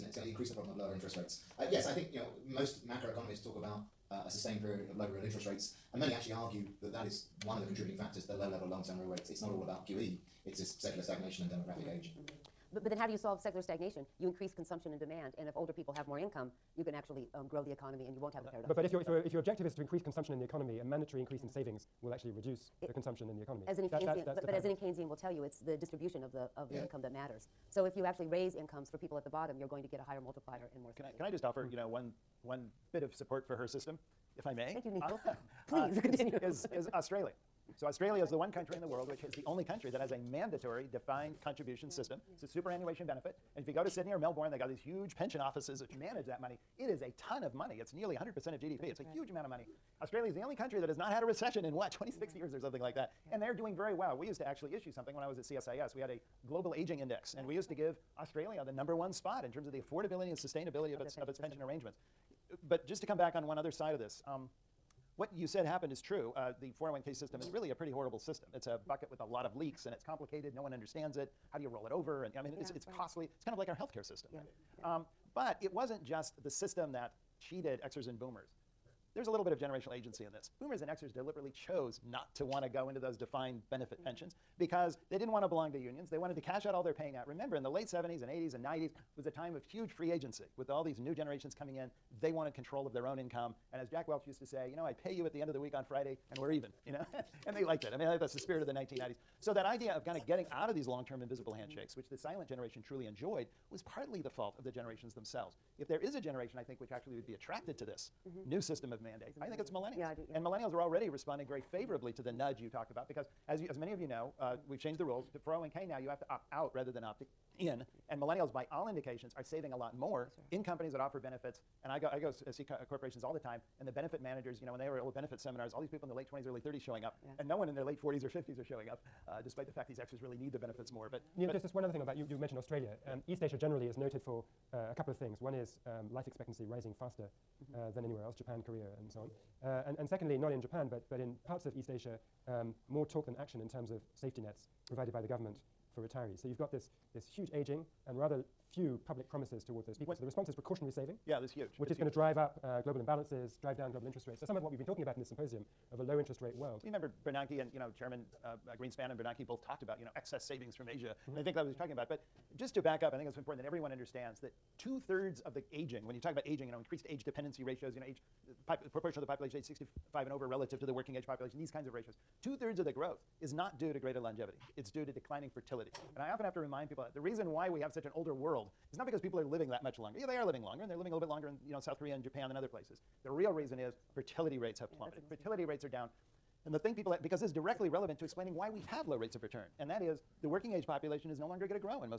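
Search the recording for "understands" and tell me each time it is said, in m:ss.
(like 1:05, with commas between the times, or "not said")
1:10, 2:43.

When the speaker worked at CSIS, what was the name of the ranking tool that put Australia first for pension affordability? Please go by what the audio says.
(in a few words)
global aging index.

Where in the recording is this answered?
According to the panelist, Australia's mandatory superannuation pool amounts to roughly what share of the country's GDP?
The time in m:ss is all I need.
0:47.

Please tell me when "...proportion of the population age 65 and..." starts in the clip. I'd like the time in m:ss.
2:48.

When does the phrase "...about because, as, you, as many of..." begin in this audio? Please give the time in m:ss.
1:52.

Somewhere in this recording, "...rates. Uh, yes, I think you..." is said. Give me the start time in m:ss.
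0:01.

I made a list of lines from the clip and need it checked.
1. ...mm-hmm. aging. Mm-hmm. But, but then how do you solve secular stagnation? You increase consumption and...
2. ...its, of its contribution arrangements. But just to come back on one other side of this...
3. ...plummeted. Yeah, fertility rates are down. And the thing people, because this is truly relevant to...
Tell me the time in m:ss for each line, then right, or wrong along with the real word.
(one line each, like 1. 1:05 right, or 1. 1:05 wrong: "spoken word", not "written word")
1. 0:11 right
2. 1:01 wrong: "pension", not "contribution"
3. 3:04 wrong: "directly", not "truly".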